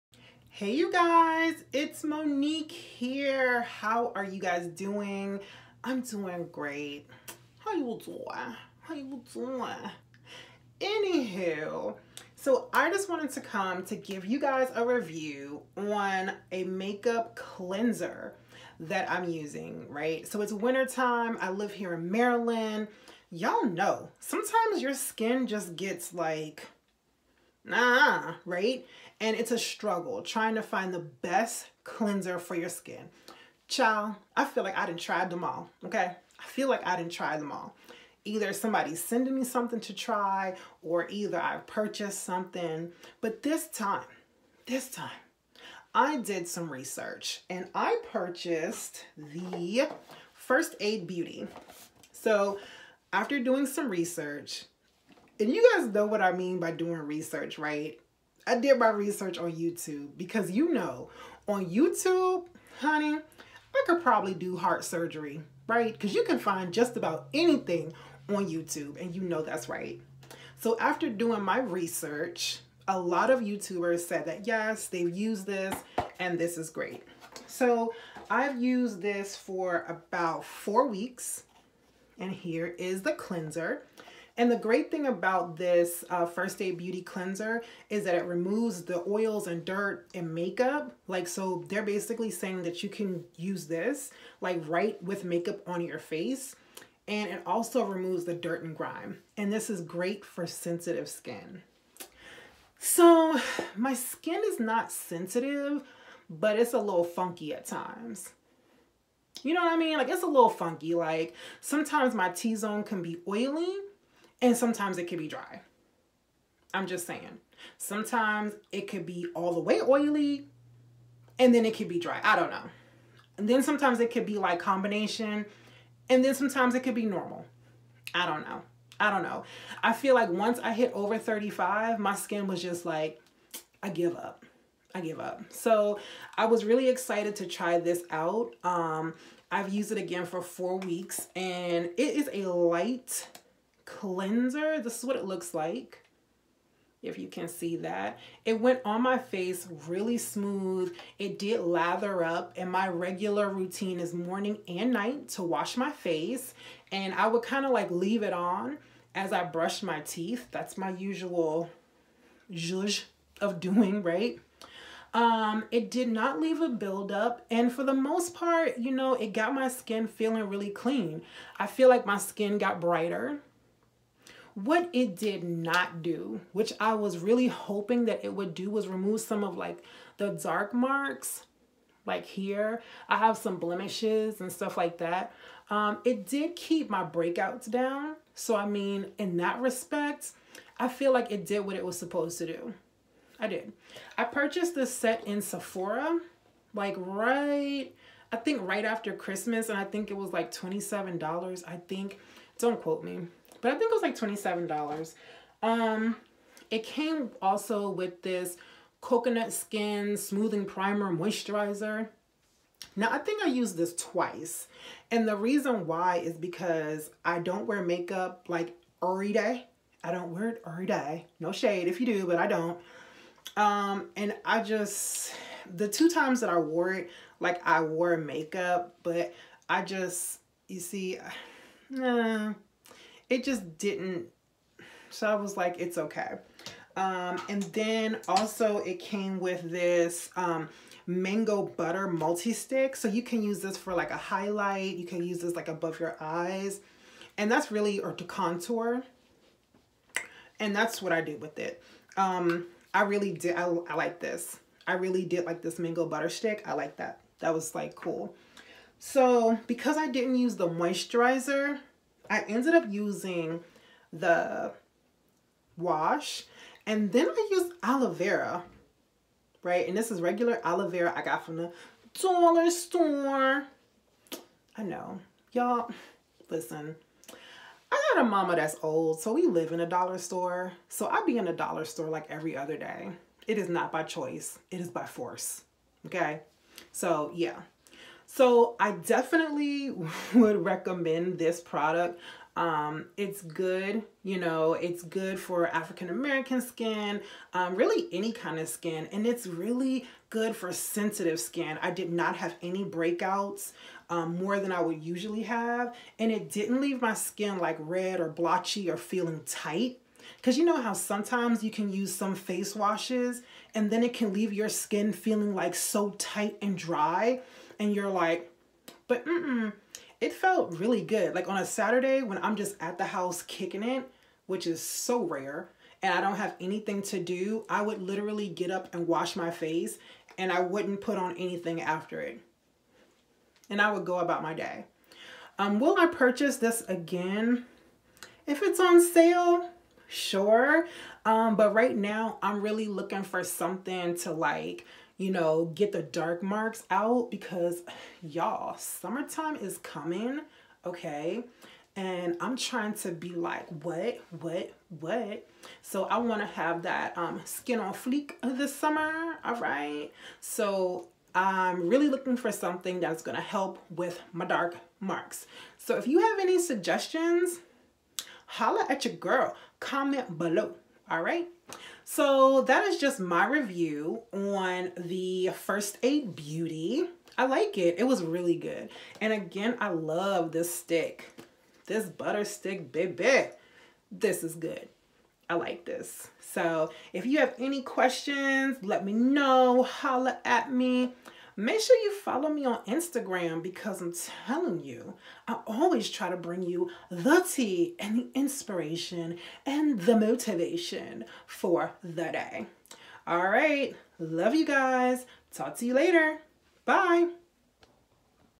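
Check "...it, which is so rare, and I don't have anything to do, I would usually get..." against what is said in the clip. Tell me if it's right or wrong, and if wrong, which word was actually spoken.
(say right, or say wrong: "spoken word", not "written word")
wrong: "literally", not "usually".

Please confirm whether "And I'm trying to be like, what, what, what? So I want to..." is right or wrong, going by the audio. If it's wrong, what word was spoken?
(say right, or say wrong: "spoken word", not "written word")
right.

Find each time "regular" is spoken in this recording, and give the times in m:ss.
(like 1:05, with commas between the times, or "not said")
2:32, 4:30.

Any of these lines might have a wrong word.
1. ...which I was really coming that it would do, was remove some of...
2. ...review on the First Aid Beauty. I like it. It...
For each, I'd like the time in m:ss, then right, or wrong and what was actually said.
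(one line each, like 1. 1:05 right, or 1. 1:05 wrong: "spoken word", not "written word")
1. 2:56 wrong: "hoping", not "coming"
2. 6:13 right.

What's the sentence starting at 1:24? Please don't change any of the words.
And the great thing about this uh, First Aid Beauty Cleanser is that it removes the oils and dirt and makeup.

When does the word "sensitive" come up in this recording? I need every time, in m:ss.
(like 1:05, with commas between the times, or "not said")
1:40, 1:44, 5:00.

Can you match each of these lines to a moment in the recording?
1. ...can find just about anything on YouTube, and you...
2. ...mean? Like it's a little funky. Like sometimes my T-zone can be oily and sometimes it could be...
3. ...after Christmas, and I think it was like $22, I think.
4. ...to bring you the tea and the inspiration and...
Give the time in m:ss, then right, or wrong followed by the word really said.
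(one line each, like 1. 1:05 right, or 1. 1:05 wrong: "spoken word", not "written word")
1. 1:06 right
2. 1:49 right
3. 3:18 wrong: "27", not "22"
4. 6:36 right.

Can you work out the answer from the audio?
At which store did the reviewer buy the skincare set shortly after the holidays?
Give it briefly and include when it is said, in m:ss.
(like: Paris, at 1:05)
Sephora, at 3:15.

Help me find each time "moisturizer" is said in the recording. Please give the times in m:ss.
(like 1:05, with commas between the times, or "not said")
3:31, 4:20.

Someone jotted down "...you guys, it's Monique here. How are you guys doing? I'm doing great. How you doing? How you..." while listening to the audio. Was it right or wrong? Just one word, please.
right.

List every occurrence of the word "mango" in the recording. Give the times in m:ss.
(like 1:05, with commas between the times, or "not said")
4:01, 4:15.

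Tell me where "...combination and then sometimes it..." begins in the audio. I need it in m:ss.
2:04.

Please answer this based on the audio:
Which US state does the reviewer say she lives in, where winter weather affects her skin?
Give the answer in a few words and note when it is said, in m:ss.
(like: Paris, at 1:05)
Maryland, at 0:22.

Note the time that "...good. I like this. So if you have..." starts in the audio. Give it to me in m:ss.
6:24.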